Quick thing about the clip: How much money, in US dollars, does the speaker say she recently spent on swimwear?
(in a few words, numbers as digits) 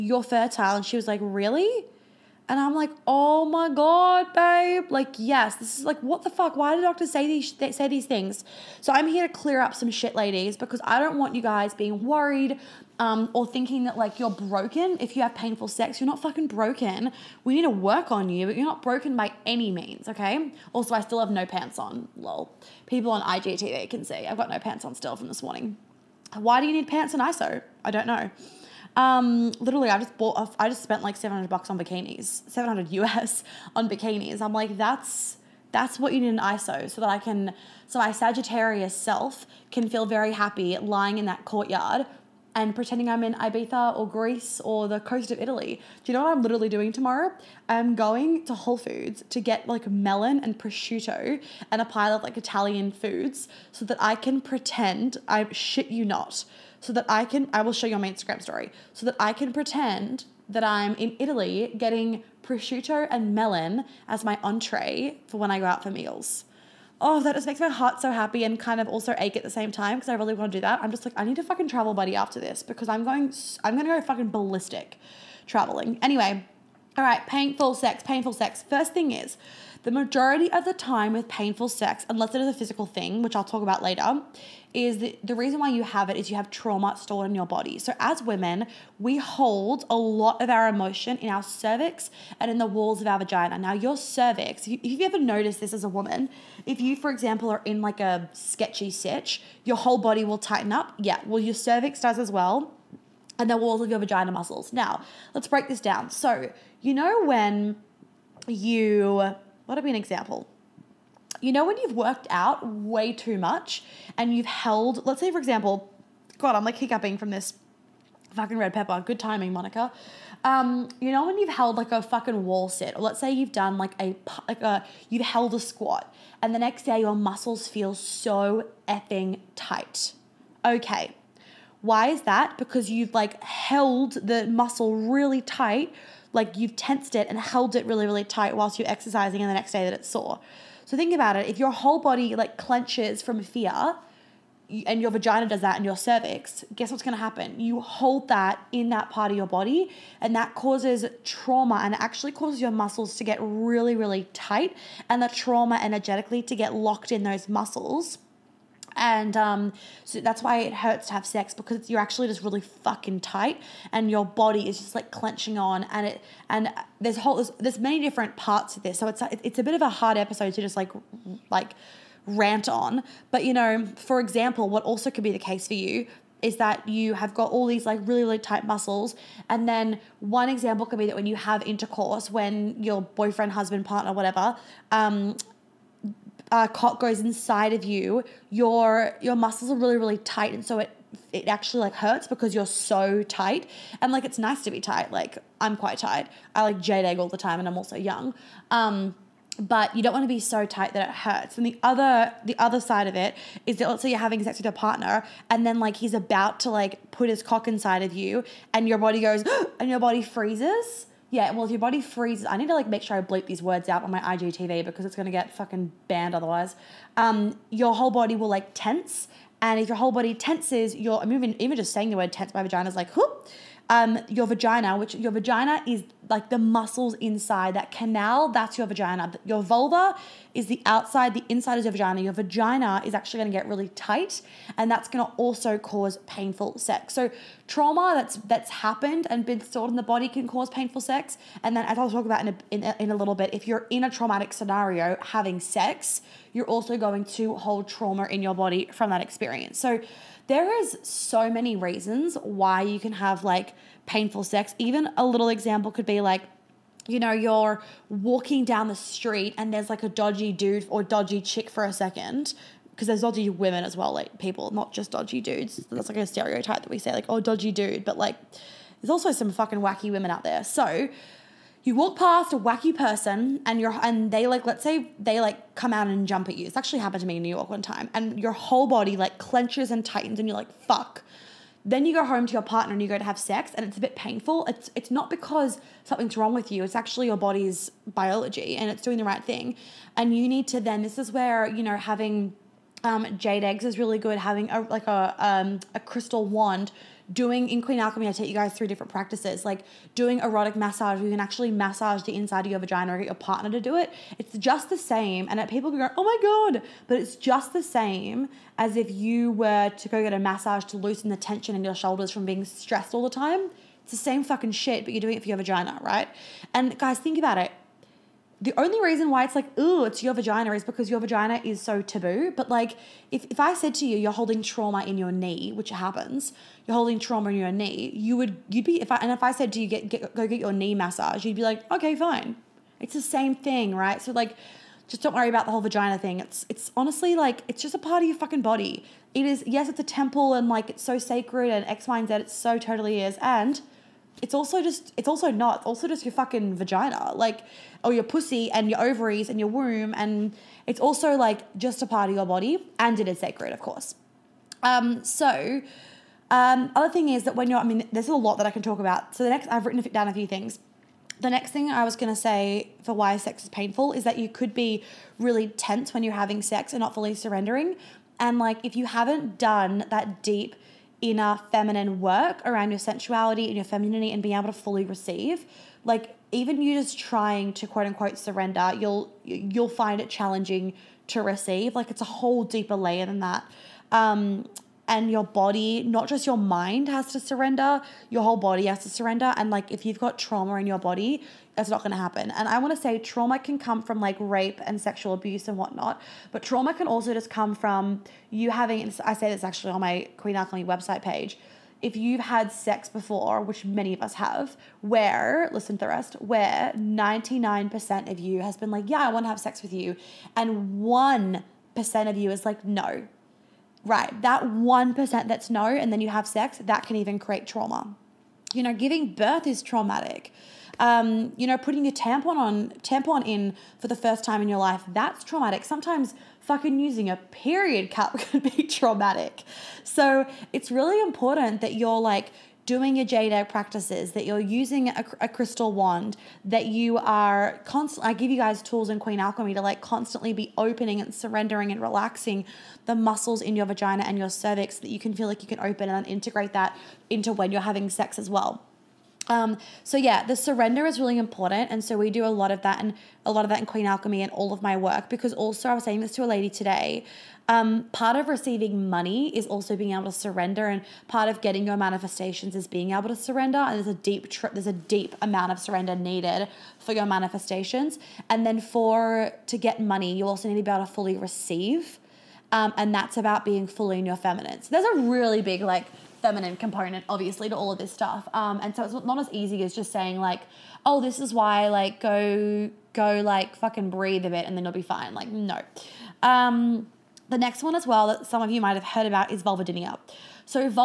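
700.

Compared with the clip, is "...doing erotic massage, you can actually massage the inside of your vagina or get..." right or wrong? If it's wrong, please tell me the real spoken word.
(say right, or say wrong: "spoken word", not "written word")
right.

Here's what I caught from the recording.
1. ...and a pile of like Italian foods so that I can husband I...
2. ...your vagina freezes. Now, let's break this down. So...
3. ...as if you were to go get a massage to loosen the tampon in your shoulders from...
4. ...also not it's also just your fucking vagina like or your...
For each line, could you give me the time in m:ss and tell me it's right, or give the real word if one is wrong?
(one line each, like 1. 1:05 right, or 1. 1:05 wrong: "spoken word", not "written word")
1. 0:51 wrong: "pretend", not "husband"
2. 1:43 wrong: "muscles", not "freezes"
3. 5:08 wrong: "tension", not "tampon"
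4. 5:45 right.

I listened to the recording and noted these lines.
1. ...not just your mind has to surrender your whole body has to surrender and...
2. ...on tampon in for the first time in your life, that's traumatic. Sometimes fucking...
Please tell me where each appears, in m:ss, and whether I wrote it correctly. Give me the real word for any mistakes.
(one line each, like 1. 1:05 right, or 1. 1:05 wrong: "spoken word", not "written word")
1. 6:26 right
2. 7:02 right.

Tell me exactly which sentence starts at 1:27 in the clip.
So, as women, we hold a lot of our emotion in our cervix and in the walls of our vagina.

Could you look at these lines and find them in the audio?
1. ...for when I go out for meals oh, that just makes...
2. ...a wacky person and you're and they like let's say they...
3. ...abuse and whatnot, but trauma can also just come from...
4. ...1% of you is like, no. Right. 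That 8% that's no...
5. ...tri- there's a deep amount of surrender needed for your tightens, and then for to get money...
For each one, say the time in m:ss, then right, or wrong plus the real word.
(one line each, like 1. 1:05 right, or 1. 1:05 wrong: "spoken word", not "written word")
1. 1:05 right
2. 4:32 right
3. 6:35 right
4. 6:51 wrong: "1", not "8"
5. 7:44 wrong: "manifestations", not "tightens".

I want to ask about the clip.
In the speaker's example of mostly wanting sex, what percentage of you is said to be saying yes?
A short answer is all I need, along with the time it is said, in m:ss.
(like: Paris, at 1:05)
99%, at 6:46.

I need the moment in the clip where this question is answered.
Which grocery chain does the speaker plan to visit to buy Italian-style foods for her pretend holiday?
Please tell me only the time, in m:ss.
0:48.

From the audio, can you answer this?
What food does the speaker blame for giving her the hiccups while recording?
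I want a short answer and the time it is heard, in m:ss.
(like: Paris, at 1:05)
red pepper, at 1:58.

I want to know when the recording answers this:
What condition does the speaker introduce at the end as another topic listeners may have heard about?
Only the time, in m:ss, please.
8:09.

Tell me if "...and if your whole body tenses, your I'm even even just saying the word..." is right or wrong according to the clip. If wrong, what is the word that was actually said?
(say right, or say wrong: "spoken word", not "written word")
right.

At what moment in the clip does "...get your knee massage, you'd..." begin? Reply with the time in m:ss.
5:30.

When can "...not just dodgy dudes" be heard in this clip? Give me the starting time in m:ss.
4:24.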